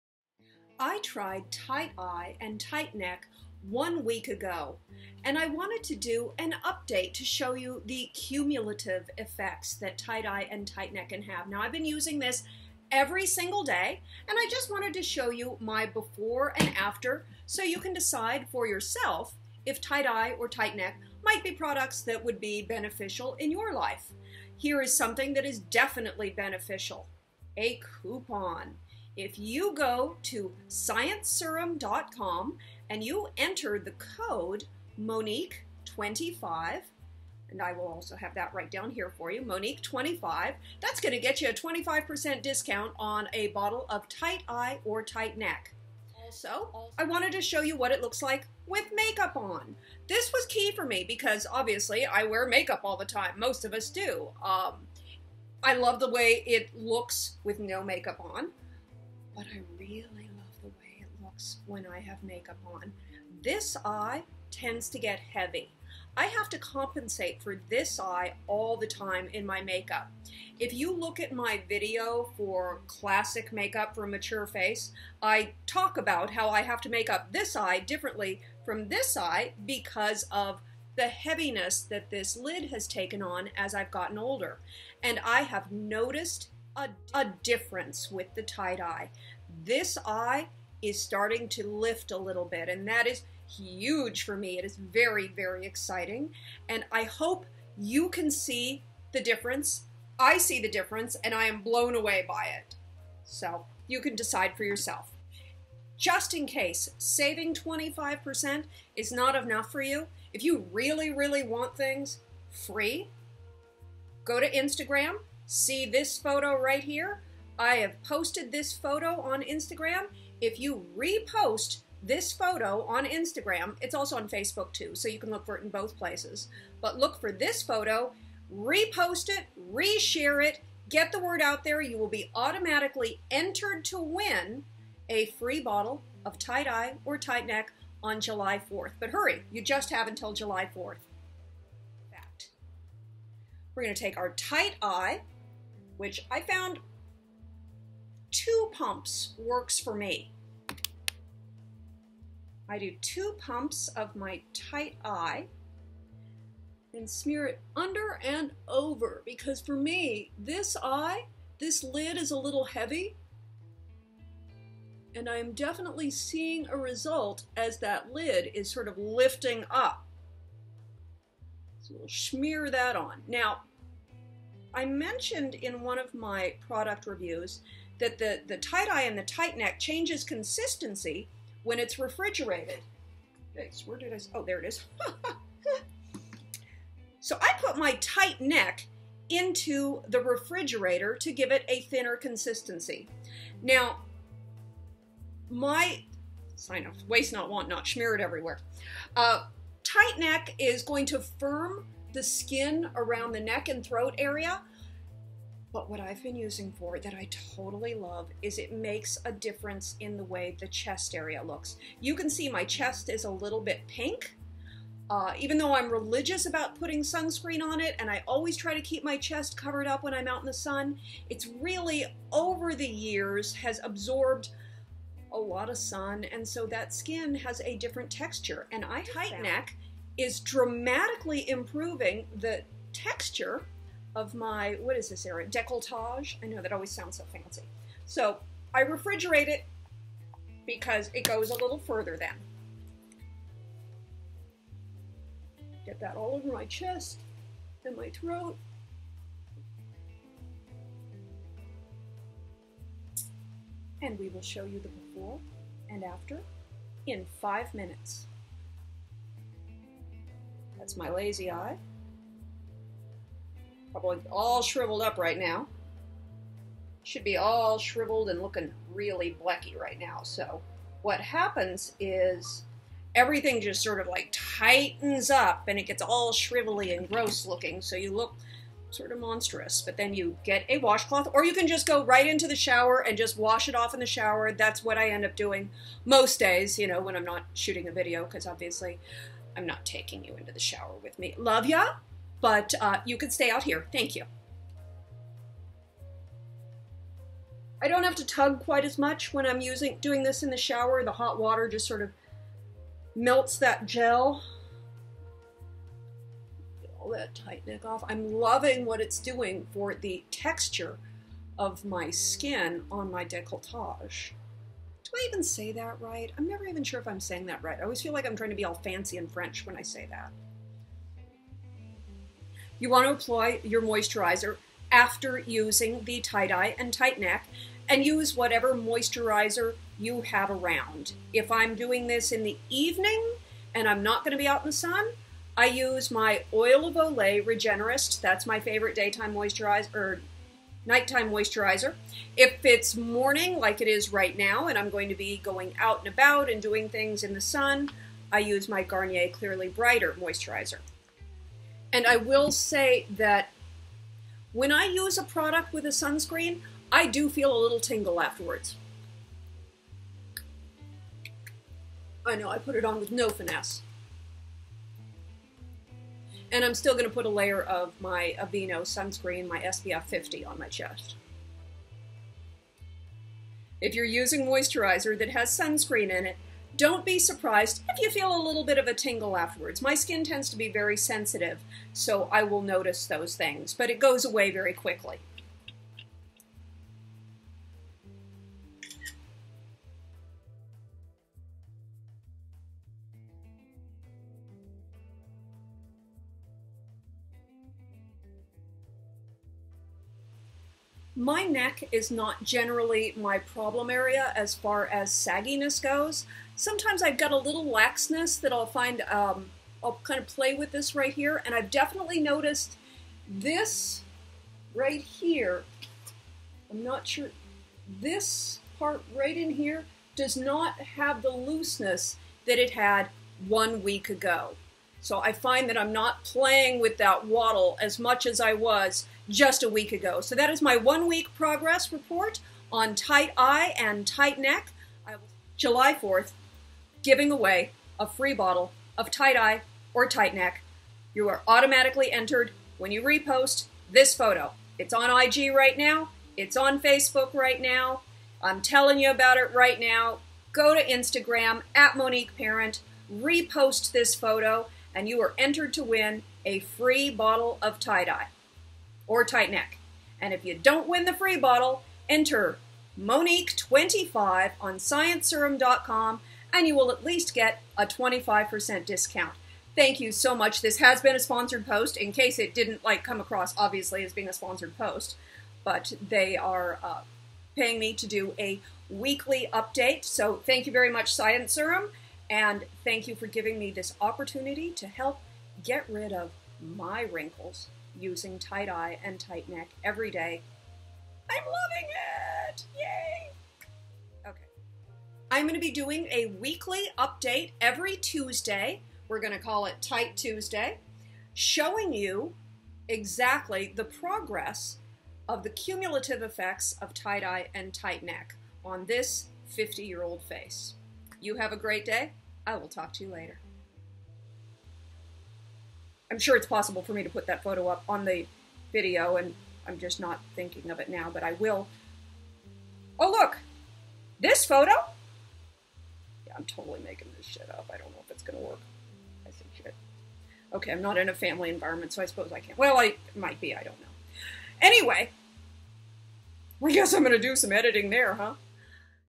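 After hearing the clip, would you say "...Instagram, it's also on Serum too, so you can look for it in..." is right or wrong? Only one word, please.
wrong.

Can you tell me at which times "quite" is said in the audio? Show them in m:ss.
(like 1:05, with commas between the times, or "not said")
4:58.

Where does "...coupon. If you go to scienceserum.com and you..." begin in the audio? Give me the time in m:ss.
0:28.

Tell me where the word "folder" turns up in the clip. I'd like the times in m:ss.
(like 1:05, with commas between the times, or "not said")
not said.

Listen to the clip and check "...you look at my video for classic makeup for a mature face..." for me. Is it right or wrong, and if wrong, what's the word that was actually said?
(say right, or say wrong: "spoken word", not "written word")
right.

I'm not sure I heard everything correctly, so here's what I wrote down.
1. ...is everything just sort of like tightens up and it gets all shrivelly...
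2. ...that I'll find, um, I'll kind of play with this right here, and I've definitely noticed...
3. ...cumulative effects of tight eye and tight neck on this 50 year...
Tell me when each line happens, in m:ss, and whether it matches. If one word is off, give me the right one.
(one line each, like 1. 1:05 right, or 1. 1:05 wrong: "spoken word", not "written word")
1. 4:31 right
2. 6:48 right
3. 8:25 right.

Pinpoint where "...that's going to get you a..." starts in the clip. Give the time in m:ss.
0:40.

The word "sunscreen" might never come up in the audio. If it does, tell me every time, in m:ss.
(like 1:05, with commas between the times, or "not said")
3:37, 5:55, 6:08, 6:15.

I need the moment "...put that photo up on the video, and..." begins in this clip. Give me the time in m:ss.
8:37.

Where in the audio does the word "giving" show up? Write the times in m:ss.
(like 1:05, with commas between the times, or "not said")
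7:17, 8:03.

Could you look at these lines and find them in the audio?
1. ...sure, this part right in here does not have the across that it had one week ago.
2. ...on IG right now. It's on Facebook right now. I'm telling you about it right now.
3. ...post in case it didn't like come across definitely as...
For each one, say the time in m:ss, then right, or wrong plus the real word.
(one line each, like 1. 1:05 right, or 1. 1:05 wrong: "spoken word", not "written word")
1. 6:57 wrong: "looseness", not "across"
2. 7:24 right
3. 7:51 wrong: "obviously", not "definitely".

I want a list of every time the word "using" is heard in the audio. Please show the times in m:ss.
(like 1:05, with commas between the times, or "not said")
0:11, 3:26, 4:59, 5:25, 6:14, 8:08.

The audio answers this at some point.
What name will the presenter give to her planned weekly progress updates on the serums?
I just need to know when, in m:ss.
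8:19.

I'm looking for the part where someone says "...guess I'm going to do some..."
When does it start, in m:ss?
8:56.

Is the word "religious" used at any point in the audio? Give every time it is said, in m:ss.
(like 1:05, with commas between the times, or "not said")
3:35.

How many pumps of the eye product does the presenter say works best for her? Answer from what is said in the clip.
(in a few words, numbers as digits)
2.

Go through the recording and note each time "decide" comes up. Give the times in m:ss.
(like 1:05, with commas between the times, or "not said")
0:17, 1:44.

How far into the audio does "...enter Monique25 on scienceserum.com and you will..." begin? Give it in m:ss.
7:42.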